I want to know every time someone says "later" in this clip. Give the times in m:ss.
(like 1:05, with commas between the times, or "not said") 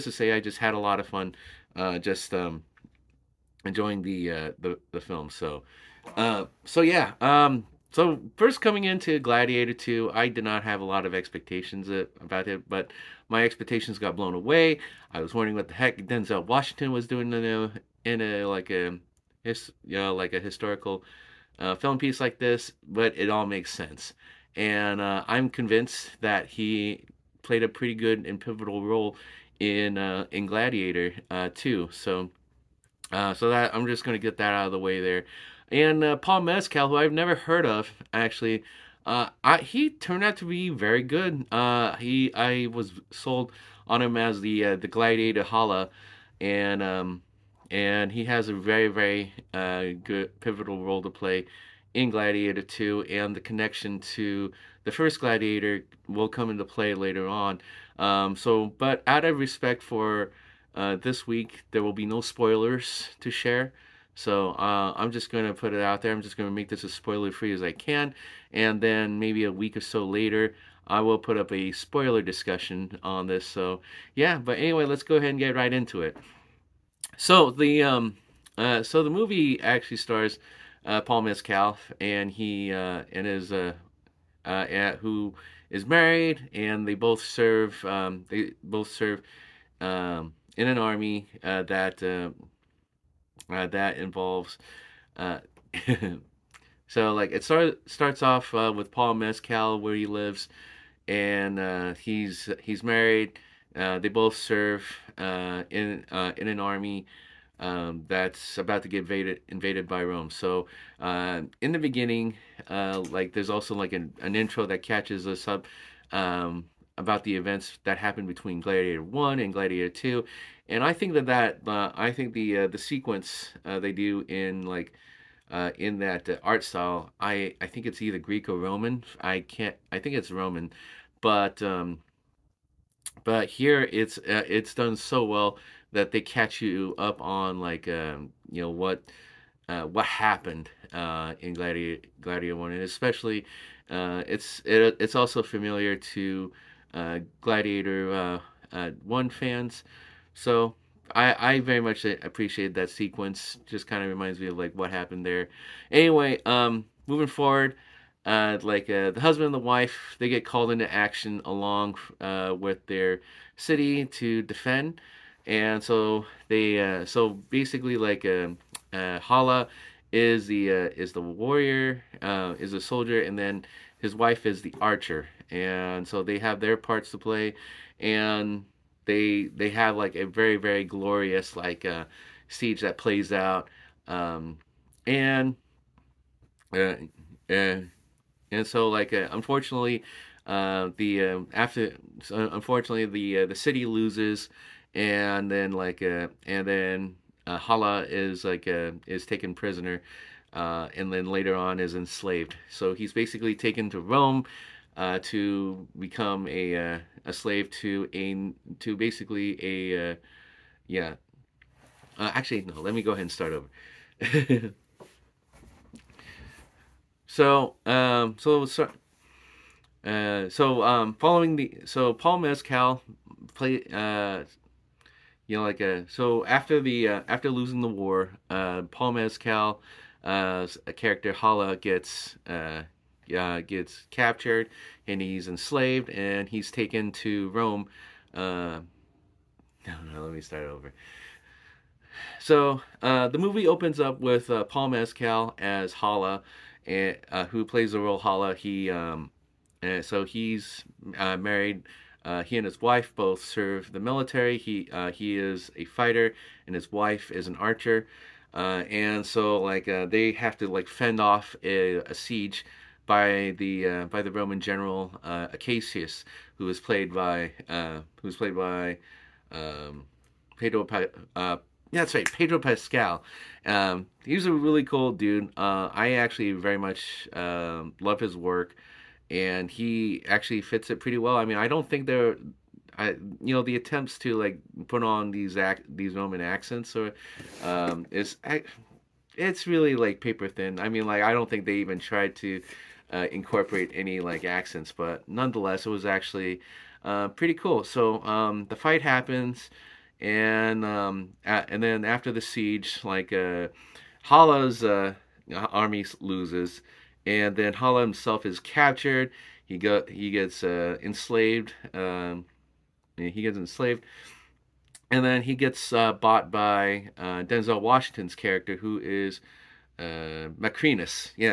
0:56, 1:10, 3:21.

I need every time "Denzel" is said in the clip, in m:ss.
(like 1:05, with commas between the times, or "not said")
0:16, 5:17.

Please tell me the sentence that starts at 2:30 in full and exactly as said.
So I, I very much appreciated that sequence.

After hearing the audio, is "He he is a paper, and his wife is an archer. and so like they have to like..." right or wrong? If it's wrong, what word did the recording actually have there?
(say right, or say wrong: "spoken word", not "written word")
wrong: "fighter", not "paper".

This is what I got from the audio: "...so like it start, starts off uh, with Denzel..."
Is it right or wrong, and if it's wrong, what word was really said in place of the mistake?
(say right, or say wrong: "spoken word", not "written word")
wrong: "Paul", not "Denzel".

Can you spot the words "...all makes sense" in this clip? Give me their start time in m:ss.
0:23.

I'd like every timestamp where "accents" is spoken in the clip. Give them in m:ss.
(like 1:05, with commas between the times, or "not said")
4:46, 4:54.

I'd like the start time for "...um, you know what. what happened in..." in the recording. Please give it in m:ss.
2:17.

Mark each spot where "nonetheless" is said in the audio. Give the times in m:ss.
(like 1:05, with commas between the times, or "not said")
4:55.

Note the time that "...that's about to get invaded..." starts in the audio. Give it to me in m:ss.
1:48.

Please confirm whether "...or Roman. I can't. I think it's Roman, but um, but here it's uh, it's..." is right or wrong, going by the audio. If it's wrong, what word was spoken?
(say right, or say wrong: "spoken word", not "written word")
right.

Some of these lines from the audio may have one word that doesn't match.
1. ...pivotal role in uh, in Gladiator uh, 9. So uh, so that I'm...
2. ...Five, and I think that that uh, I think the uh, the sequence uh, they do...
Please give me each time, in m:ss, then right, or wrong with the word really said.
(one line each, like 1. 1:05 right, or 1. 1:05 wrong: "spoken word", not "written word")
1. 0:28 wrong: "2", not "9"
2. 1:59 wrong: "Two", not "Five".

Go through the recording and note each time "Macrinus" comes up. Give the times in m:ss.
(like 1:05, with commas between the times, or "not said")
5:20.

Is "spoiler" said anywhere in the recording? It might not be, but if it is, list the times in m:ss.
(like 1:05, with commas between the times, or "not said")
1:02, 1:06, 1:11.